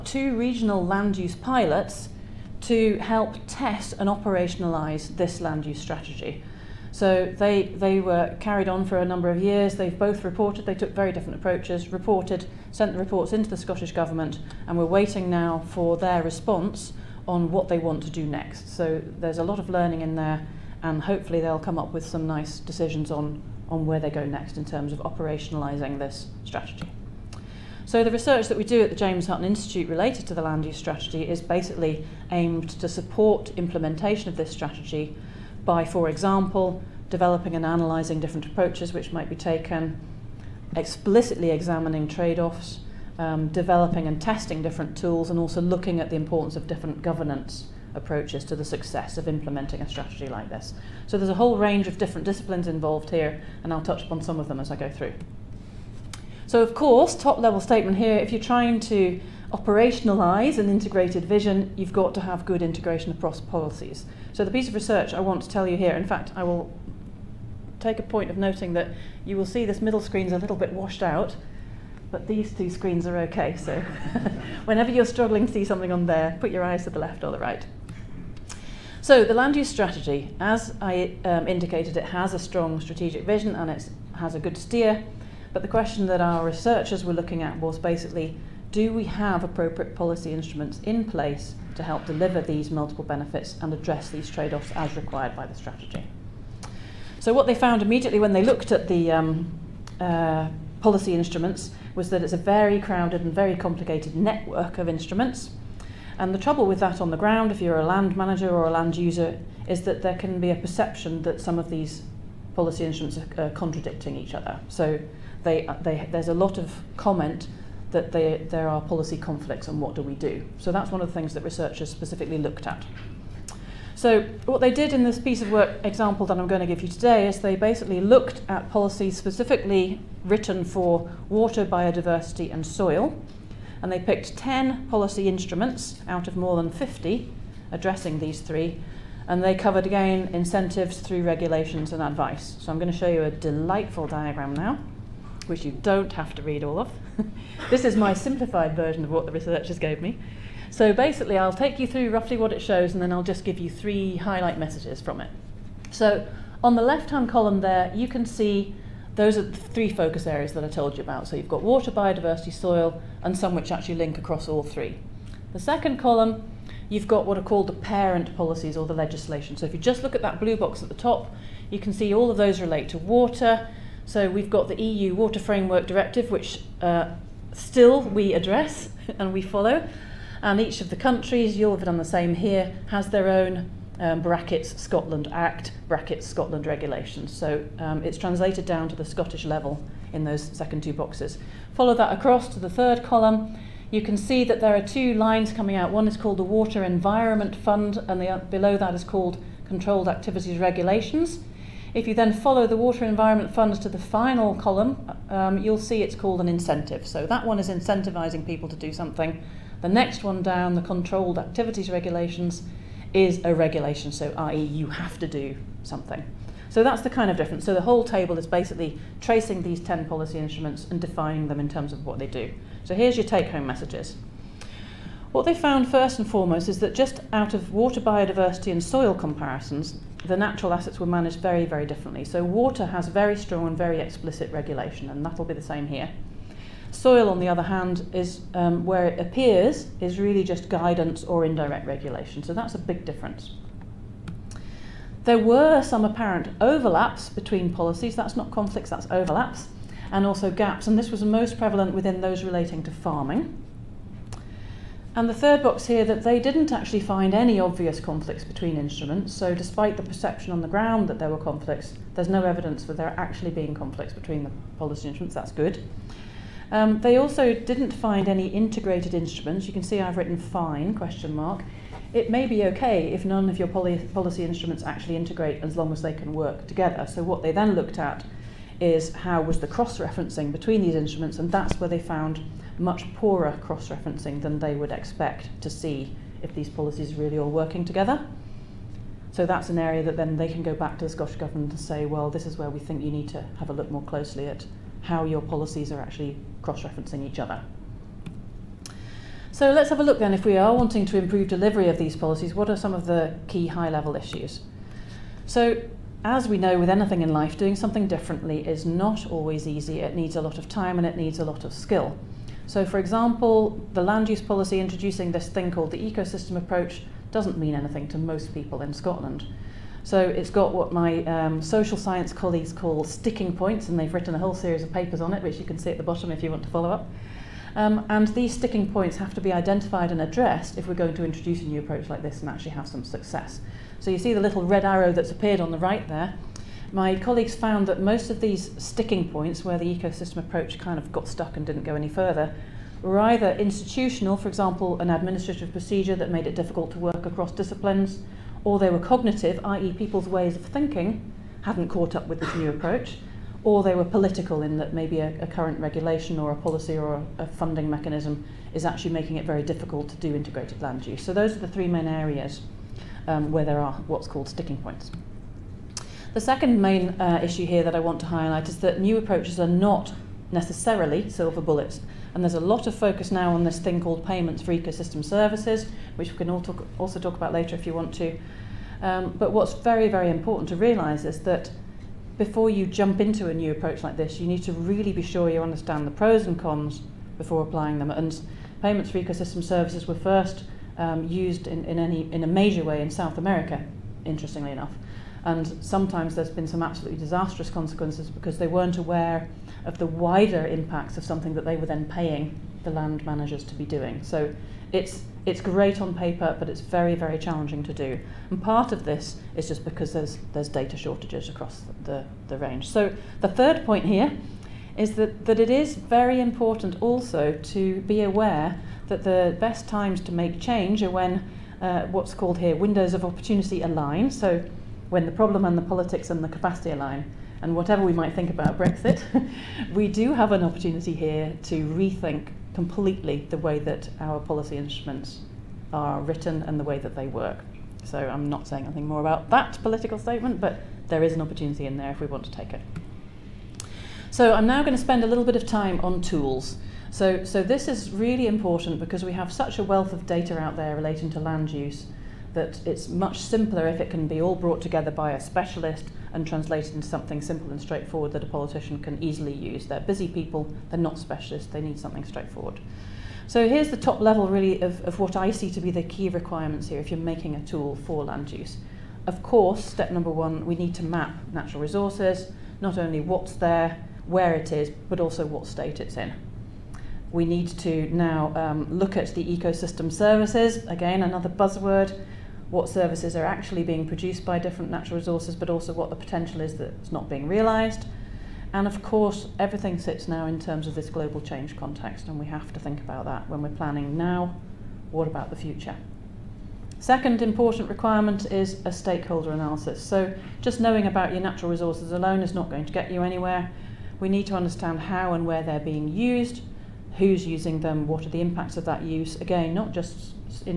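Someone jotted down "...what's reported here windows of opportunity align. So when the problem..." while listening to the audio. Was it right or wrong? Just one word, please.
wrong.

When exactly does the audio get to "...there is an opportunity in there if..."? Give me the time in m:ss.
7:21.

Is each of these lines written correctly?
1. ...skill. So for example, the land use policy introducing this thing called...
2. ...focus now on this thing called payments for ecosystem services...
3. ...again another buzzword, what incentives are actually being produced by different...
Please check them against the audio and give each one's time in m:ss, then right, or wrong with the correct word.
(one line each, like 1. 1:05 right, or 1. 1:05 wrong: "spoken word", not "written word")
1. 5:11 right
2. 6:12 right
3. 8:00 wrong: "services", not "incentives".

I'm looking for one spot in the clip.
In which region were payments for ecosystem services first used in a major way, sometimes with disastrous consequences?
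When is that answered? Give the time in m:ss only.
6:33.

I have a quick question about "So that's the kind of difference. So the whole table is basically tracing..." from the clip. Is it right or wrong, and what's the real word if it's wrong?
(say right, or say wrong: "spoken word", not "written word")
right.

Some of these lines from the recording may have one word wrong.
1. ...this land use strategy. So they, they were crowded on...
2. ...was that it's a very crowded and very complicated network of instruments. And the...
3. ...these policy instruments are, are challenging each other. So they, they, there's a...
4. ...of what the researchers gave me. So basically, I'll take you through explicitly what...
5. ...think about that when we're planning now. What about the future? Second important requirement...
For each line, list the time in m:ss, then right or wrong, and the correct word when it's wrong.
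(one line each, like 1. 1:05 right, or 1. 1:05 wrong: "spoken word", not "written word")
1. 0:05 wrong: "carried", not "crowded"
2. 1:41 right
3. 1:51 wrong: "contradicting", not "challenging"
4. 2:29 wrong: "roughly", not "explicitly"
5. 8:12 right.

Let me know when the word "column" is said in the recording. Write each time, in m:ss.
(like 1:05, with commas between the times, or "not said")
2:37, 2:45, 3:13, 3:24.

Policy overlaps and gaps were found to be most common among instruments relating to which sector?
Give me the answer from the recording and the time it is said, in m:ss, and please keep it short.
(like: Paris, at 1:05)
Farming, at 4:12.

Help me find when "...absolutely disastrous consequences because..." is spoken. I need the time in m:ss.
6:36.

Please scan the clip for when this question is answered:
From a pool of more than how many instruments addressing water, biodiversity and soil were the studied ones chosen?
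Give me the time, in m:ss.
2:16.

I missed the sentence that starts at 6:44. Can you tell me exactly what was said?
So it's it's great on paper, but it's very very challenging to do.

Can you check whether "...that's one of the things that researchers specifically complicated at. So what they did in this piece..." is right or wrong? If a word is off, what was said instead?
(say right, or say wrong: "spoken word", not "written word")
wrong: "looked", not "complicated".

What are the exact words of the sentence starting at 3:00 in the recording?
And each of the countries, you'll have done the same here, has their own um, brackets Scotland Act, brackets Scotland regulations.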